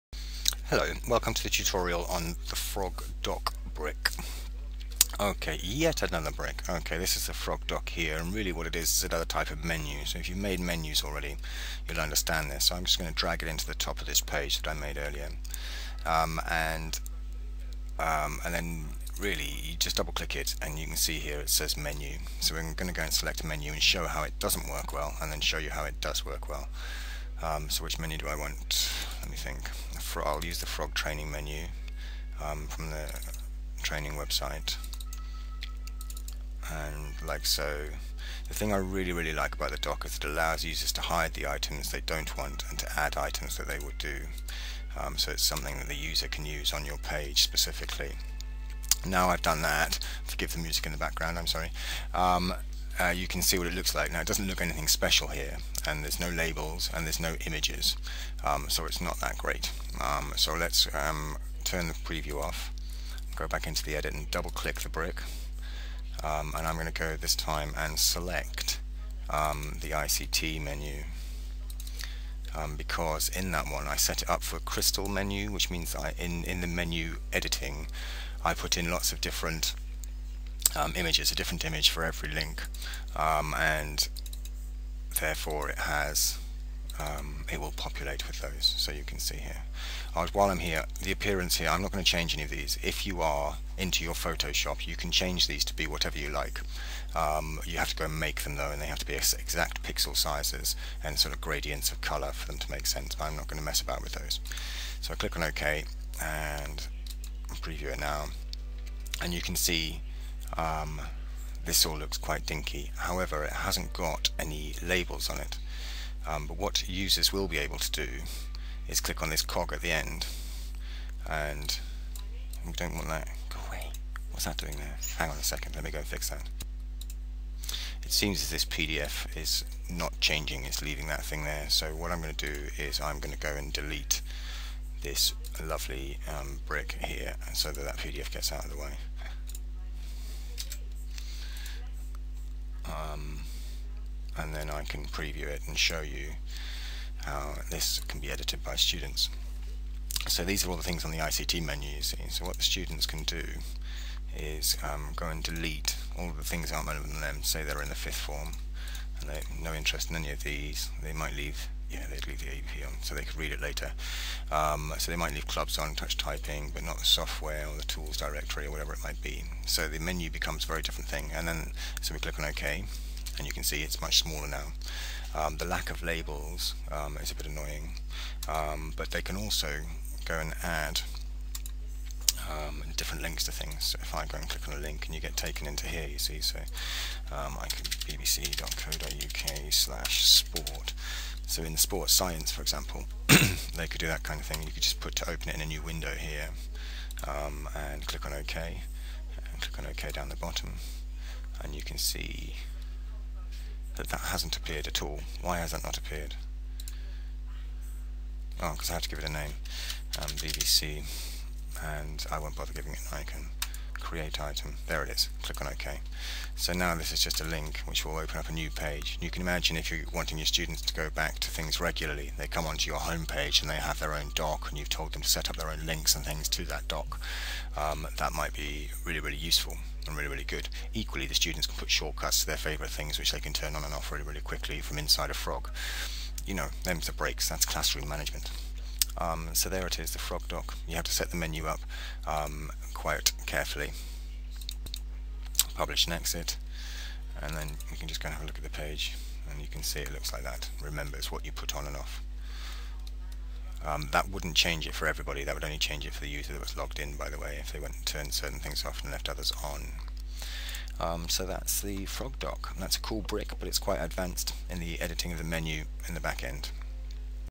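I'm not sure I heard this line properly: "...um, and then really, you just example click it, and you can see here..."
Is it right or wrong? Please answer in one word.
wrong.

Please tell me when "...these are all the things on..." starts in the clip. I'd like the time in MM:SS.
02:30.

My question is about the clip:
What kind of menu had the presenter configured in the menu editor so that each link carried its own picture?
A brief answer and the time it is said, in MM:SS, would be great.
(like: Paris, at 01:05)
crystal menu, at 01:14.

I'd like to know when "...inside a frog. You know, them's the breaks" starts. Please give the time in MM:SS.
03:54.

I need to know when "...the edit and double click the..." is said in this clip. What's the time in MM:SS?
01:03.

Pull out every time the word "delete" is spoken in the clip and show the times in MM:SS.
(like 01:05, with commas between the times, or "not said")
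02:13, 02:35.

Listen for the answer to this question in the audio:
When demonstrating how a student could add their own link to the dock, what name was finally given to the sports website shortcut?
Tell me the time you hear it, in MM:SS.
03:30.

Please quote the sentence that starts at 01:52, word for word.
However, it hasn't got any labels on it.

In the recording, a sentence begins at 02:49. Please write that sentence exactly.
So the menu becomes a very different thing.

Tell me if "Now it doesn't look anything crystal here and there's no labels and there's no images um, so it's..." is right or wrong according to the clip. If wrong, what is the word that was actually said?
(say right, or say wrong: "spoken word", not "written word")
wrong: "special", not "crystal".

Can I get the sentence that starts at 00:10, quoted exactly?
So if you've made menus already, you'll understand this.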